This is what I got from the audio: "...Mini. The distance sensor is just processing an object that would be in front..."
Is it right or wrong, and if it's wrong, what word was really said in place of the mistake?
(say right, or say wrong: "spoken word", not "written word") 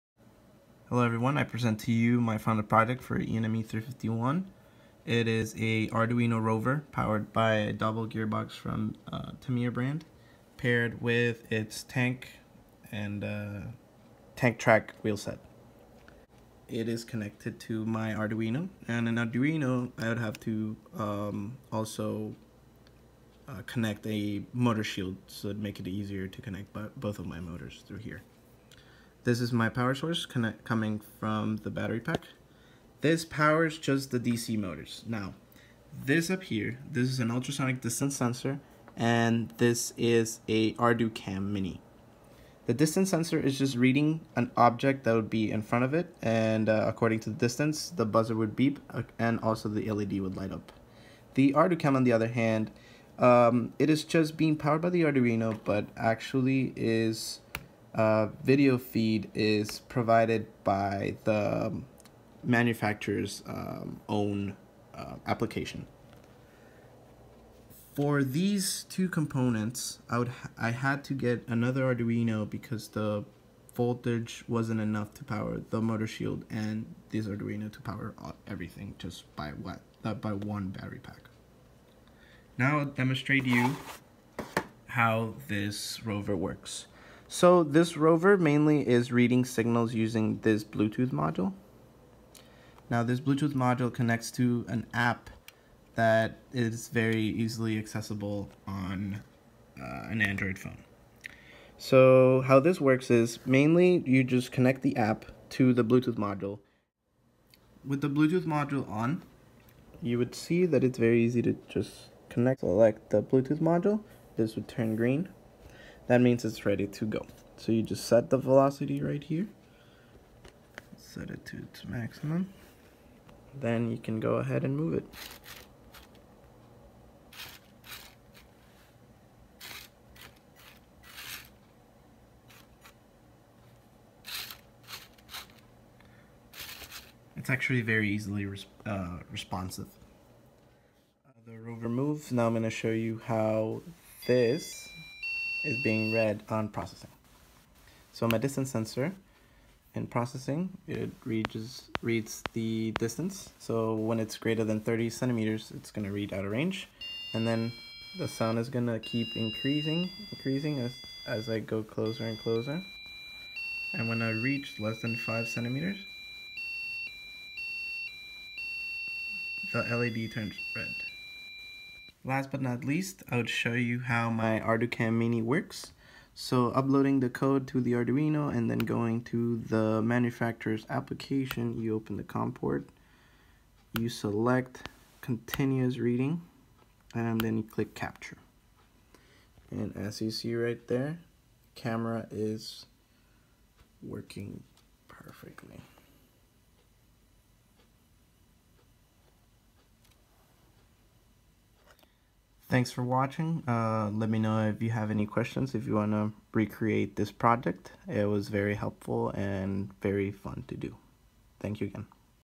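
wrong: "reading", not "processing".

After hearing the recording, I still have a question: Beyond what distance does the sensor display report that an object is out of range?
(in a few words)
30 centimeters.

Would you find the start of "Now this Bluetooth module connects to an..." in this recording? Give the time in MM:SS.
01:32.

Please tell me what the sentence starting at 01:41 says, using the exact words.
So how this works is mainly you just connect the app to the Bluetooth module.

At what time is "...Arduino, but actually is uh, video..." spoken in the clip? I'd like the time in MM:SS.
00:55.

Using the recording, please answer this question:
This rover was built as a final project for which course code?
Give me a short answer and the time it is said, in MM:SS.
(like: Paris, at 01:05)
ENME 351, at 00:03.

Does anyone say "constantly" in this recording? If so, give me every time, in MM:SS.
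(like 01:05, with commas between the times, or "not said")
not said.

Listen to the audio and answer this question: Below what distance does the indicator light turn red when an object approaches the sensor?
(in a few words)
5 centimeters.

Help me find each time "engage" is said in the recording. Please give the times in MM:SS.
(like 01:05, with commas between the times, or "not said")
not said.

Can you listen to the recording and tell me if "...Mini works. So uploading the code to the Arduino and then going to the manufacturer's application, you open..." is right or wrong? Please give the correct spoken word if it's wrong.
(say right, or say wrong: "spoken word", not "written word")
right.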